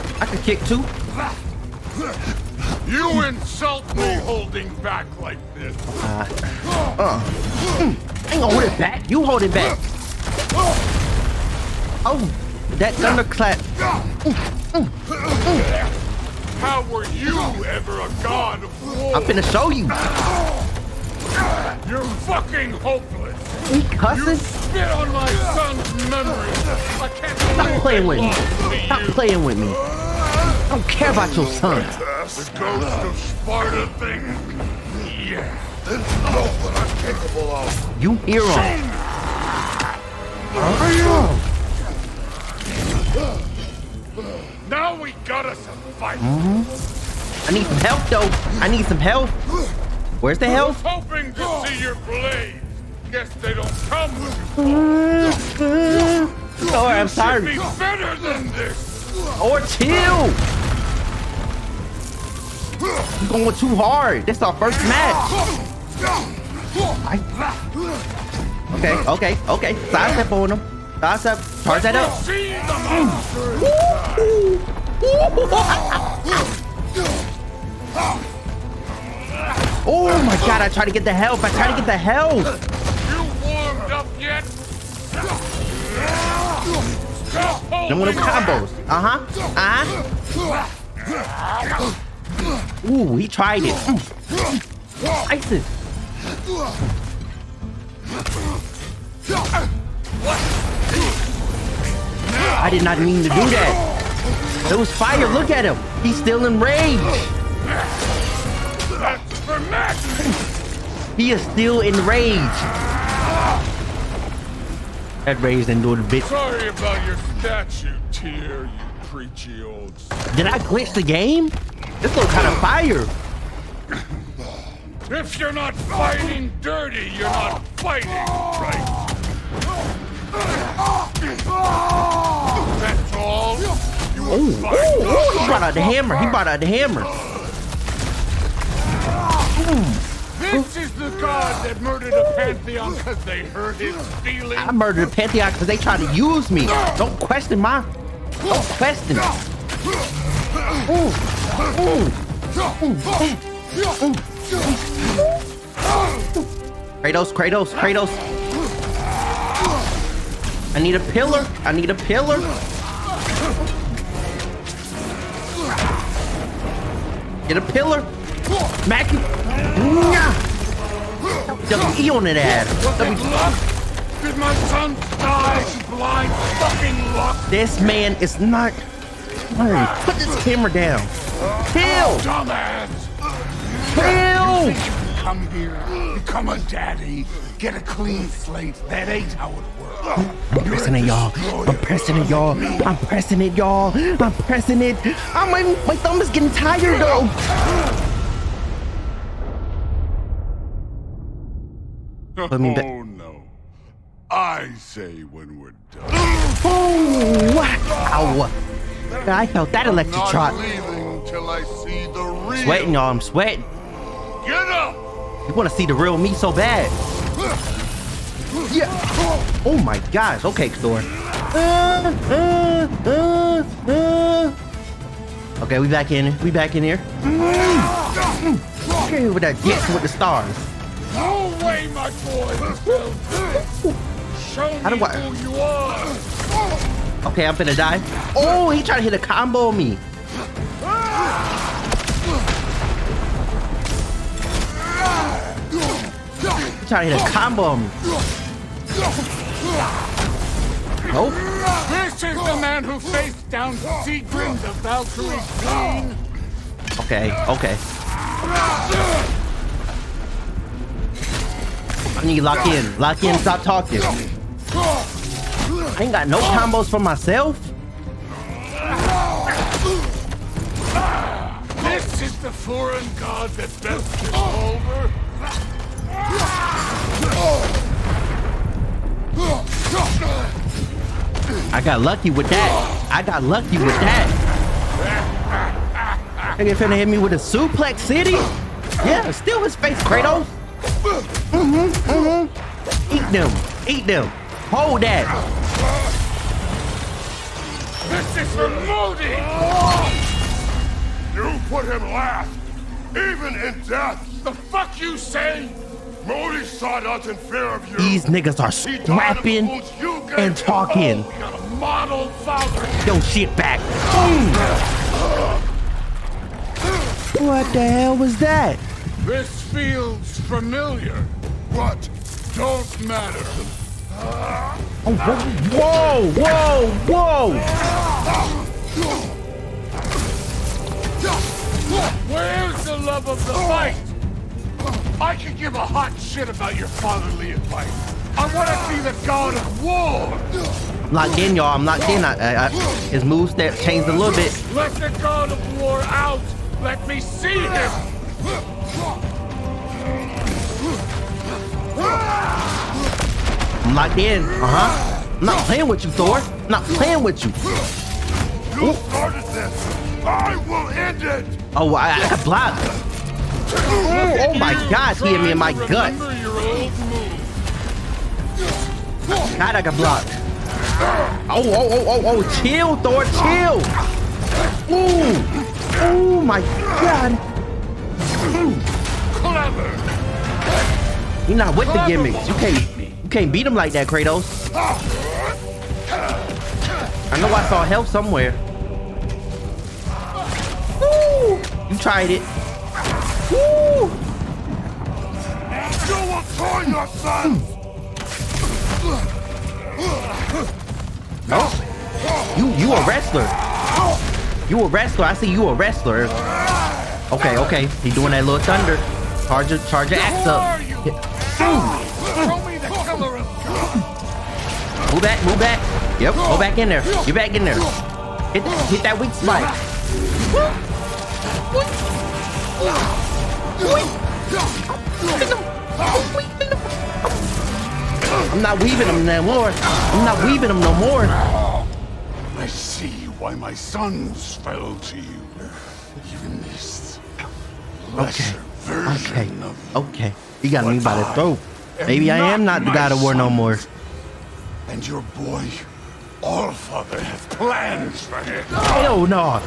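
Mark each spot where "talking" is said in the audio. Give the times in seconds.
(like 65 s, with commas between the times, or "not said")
263 s, 310 s.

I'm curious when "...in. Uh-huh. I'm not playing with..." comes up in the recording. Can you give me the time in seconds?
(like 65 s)
354 s.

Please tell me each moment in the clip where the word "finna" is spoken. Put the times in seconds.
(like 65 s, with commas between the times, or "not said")
19 s, 286 s.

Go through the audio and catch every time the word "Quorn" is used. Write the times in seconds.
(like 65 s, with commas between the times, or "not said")
not said.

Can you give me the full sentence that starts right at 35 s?
Yeah, that's not what I'm capable of.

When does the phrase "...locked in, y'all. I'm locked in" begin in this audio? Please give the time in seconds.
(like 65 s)
341 s.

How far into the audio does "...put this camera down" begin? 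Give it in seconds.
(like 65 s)
180 s.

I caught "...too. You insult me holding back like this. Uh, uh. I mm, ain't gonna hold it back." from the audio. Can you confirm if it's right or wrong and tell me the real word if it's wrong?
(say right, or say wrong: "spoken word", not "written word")
right.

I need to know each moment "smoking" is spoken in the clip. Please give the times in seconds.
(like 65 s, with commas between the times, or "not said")
not said.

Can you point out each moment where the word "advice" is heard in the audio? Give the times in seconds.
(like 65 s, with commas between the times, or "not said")
337 s.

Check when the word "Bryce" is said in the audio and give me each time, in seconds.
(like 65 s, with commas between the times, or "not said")
not said.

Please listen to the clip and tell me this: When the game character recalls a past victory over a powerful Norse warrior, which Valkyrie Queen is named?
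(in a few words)
Sigrun.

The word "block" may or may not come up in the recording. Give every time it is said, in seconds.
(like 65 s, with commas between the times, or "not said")
362 s, 369 s.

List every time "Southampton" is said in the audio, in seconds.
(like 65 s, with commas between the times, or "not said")
not said.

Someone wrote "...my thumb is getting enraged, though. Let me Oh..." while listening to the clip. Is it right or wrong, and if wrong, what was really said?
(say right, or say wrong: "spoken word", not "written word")
wrong: "tired", not "enraged".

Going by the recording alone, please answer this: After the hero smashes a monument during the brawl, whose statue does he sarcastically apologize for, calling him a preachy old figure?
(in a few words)
Tyr.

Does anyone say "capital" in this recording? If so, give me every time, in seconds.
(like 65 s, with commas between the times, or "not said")
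not said.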